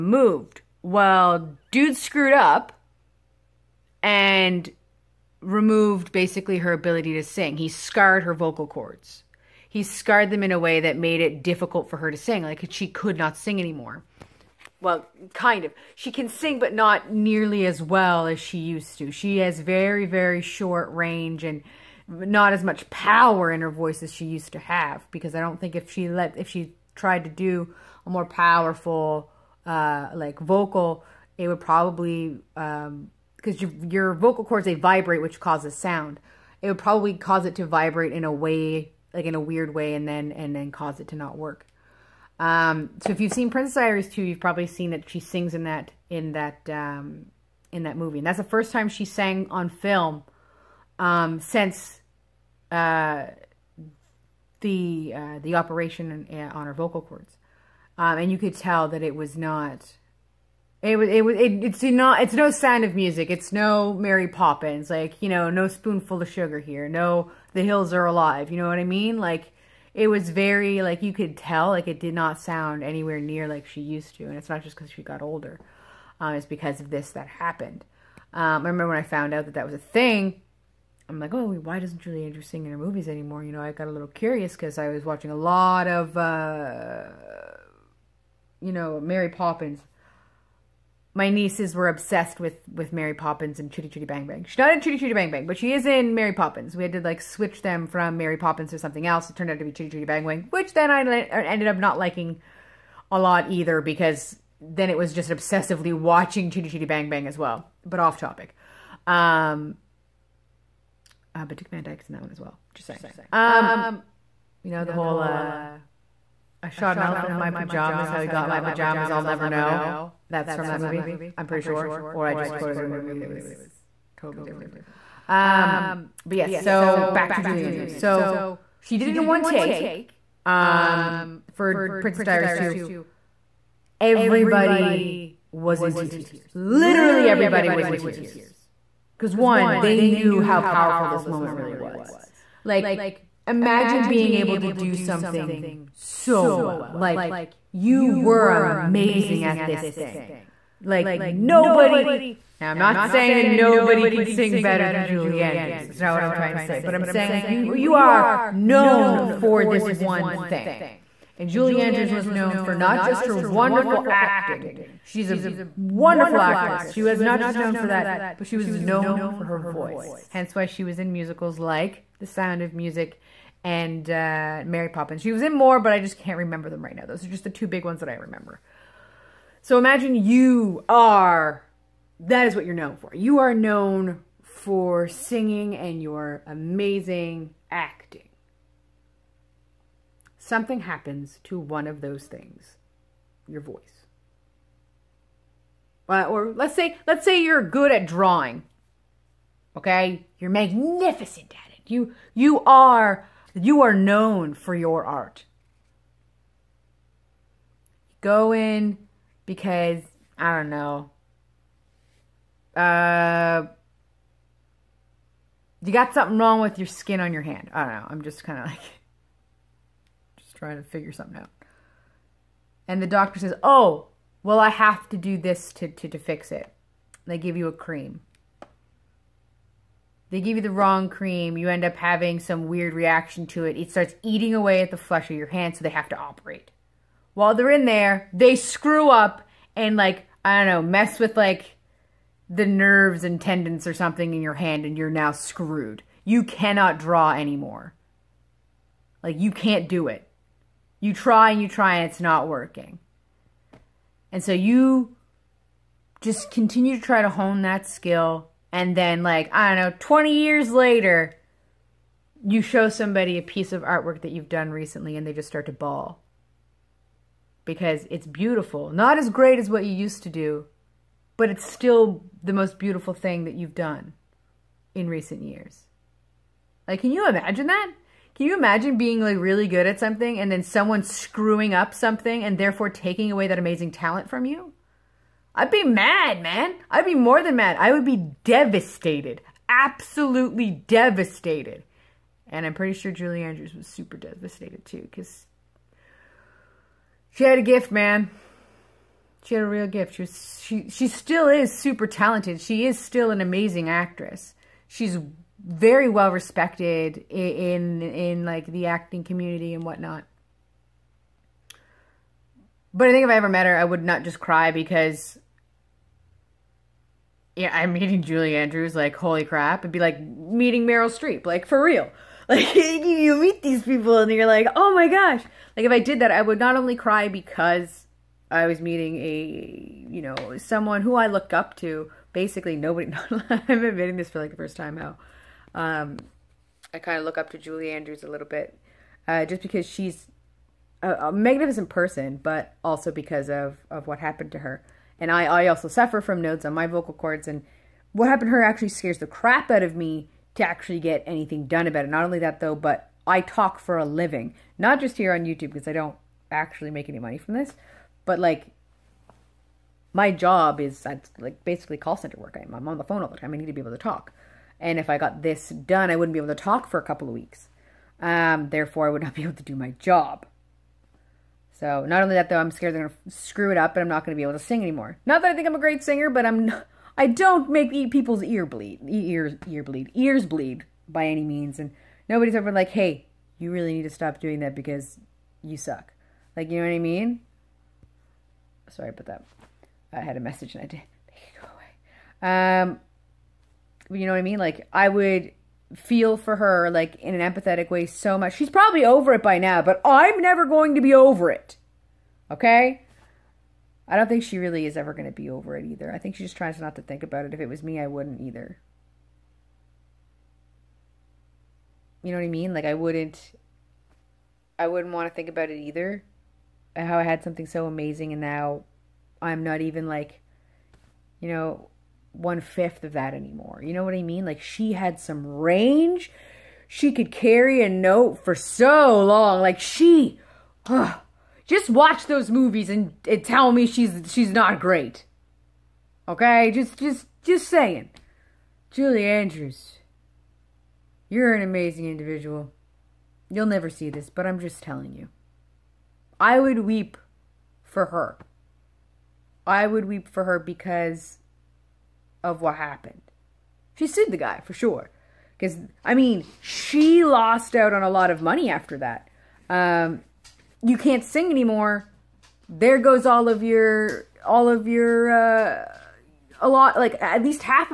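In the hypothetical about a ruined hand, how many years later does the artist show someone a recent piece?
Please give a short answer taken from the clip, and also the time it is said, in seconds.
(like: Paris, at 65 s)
20, at 259 s.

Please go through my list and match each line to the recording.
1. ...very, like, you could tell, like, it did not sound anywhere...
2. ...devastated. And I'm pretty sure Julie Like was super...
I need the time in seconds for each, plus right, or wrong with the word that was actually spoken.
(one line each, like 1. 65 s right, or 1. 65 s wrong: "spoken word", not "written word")
1. 70 s right
2. 290 s wrong: "Andrews", not "Like".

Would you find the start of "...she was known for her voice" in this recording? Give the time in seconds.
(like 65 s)
168 s.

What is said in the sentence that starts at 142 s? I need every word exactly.
Like, imagine being able to do something so well.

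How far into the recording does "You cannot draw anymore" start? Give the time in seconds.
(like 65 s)
246 s.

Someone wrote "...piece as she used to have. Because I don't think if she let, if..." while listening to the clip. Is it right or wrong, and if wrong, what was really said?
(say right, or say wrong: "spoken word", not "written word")
wrong: "voice", not "piece".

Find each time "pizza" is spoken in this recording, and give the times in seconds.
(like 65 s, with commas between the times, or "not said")
not said.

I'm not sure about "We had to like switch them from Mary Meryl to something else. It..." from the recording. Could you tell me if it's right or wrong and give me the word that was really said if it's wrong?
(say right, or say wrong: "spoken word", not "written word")
wrong: "Poppins", not "Meryl".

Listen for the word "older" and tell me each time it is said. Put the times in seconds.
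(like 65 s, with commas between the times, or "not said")
75 s.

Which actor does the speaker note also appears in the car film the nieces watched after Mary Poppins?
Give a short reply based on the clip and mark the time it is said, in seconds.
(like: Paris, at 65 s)
Dick Van Dyke, at 111 s.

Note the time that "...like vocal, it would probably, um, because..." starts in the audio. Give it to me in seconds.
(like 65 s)
30 s.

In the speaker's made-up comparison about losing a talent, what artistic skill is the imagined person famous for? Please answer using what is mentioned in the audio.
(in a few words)
Drawing.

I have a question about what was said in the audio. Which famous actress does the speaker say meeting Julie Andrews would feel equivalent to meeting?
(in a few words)
Meryl Streep.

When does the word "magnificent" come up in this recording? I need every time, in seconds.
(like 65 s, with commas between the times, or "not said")
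200 s, 341 s.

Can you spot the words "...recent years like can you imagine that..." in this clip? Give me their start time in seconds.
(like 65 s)
275 s.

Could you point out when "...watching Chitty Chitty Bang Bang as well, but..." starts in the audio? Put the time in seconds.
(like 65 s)
105 s.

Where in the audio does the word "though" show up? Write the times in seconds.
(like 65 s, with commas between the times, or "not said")
352 s, 372 s.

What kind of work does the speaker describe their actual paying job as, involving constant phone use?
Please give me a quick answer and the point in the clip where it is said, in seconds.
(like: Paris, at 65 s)
Call center work, at 361 s.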